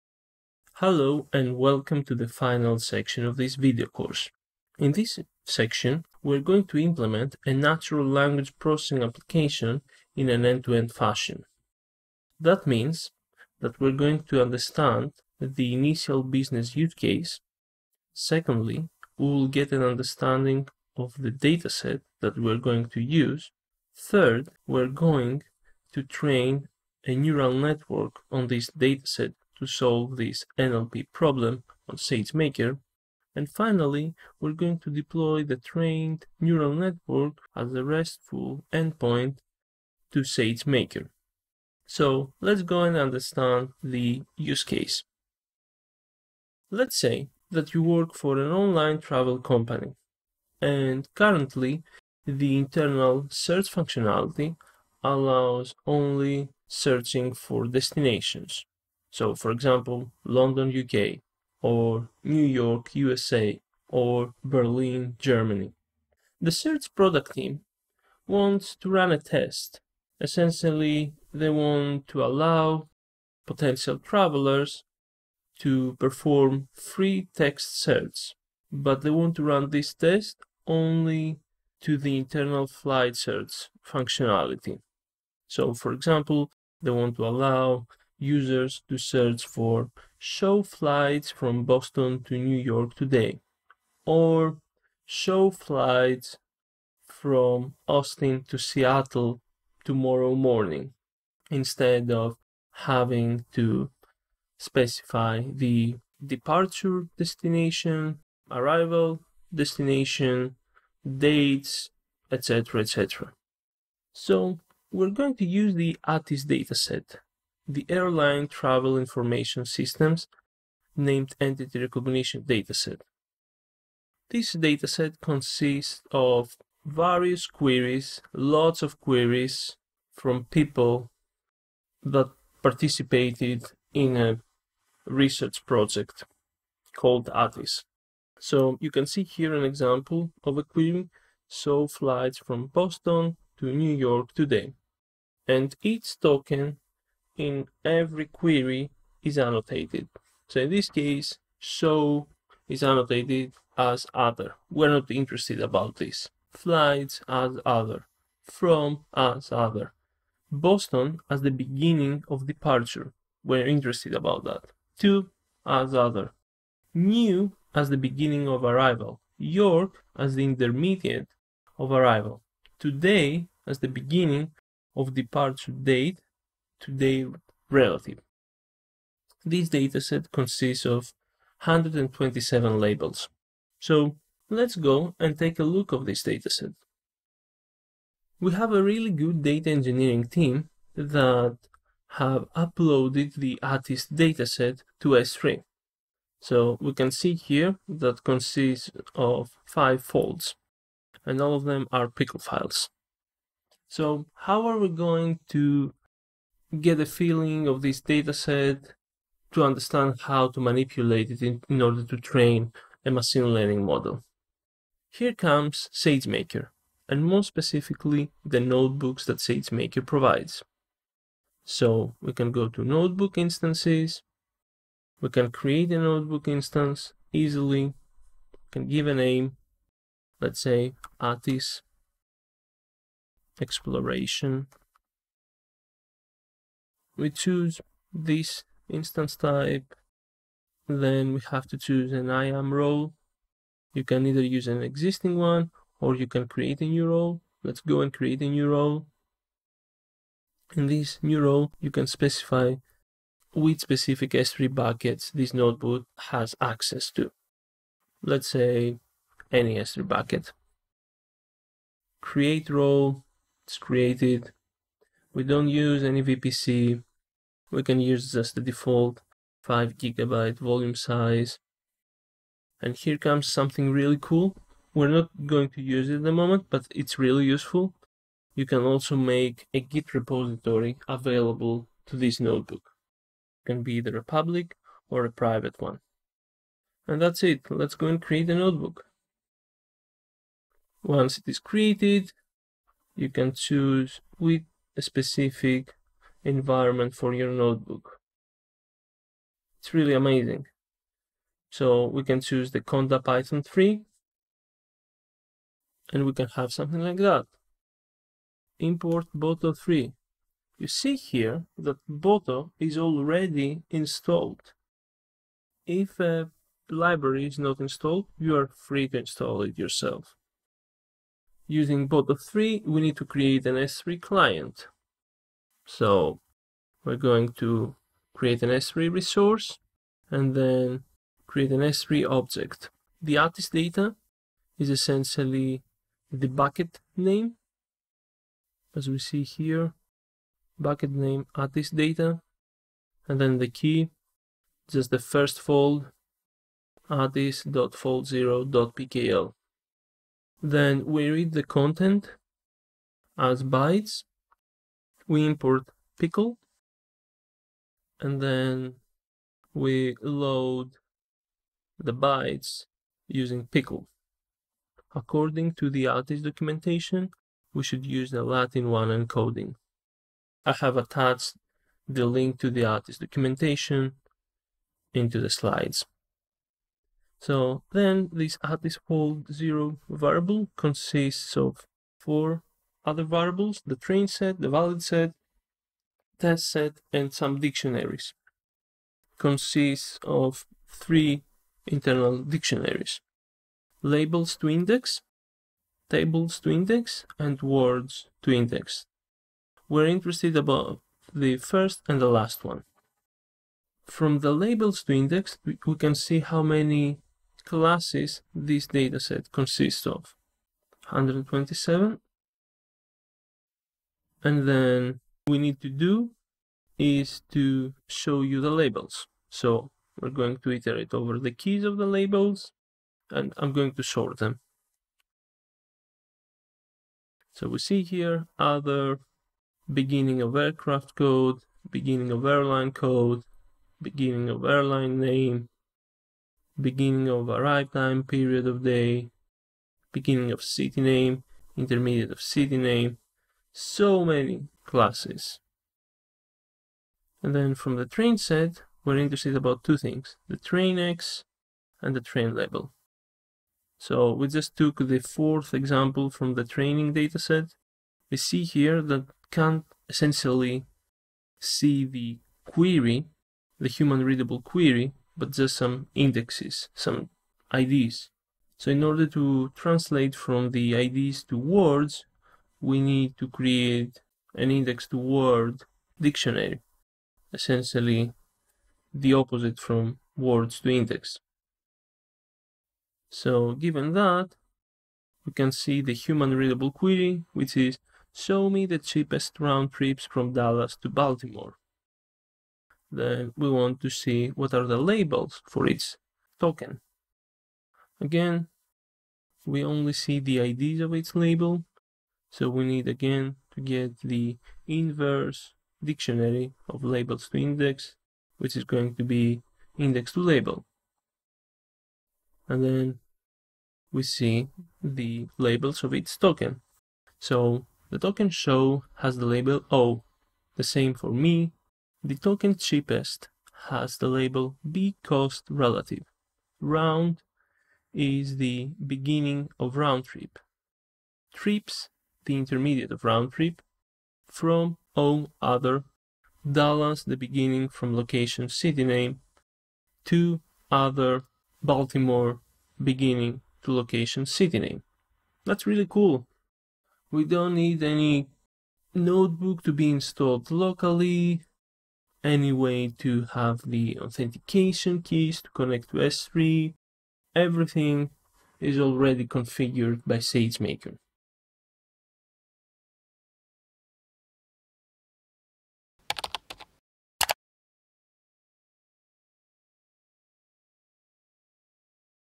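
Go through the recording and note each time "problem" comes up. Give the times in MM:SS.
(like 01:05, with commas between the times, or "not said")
00:31.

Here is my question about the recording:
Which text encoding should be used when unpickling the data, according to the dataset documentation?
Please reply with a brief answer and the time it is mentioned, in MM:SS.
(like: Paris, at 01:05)
Latin one, at 06:08.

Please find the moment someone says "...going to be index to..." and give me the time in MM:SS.
08:28.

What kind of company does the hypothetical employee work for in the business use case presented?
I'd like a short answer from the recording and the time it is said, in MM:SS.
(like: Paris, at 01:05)
Online travel company, at 00:48.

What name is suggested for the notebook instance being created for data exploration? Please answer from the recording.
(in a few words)
Atis Exploration.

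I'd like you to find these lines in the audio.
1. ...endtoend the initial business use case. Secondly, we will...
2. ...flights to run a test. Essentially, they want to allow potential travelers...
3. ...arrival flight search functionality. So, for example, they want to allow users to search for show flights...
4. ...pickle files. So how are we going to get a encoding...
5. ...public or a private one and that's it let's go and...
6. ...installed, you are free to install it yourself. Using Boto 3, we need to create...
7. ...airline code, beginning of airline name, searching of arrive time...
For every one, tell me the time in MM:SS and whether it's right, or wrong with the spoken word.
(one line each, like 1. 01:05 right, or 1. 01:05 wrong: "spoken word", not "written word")
1. 00:14 wrong: "understand", not "endtoend"
2. 01:08 wrong: "wants", not "flights"
3. 01:22 wrong: "internal", not "arrival"
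4. 03:22 wrong: "feeling", not "encoding"
5. 04:44 right
6. 05:17 right
7. 07:12 wrong: "beginning", not "searching".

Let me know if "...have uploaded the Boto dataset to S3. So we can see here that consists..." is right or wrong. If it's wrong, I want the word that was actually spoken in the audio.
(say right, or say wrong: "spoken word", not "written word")
wrong: "ATIS", not "Boto".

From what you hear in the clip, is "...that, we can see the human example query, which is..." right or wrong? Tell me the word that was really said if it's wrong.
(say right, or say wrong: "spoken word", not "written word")
wrong: "readable", not "example".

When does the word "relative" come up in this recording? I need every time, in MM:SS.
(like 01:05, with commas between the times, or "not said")
02:57, 08:45.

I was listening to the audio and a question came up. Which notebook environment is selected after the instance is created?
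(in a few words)
Conda Python 3.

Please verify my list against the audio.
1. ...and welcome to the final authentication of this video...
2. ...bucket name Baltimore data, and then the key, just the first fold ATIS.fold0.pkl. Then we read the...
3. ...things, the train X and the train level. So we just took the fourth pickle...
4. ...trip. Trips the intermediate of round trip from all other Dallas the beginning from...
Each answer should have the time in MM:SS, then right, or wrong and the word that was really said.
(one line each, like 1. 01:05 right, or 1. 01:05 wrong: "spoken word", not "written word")
1. 00:01 wrong: "section", not "authentication"
2. 05:40 wrong: "ATIS", not "Baltimore"
3. 07:29 wrong: "example", not "pickle"
4. 08:50 right.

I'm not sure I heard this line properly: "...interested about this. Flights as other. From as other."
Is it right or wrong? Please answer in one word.
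right.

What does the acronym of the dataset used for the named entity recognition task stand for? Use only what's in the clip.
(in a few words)
Airline Travel Information Systems.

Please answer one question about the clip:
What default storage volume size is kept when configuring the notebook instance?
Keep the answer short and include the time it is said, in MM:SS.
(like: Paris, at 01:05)
5 gigabytes, at 04:29.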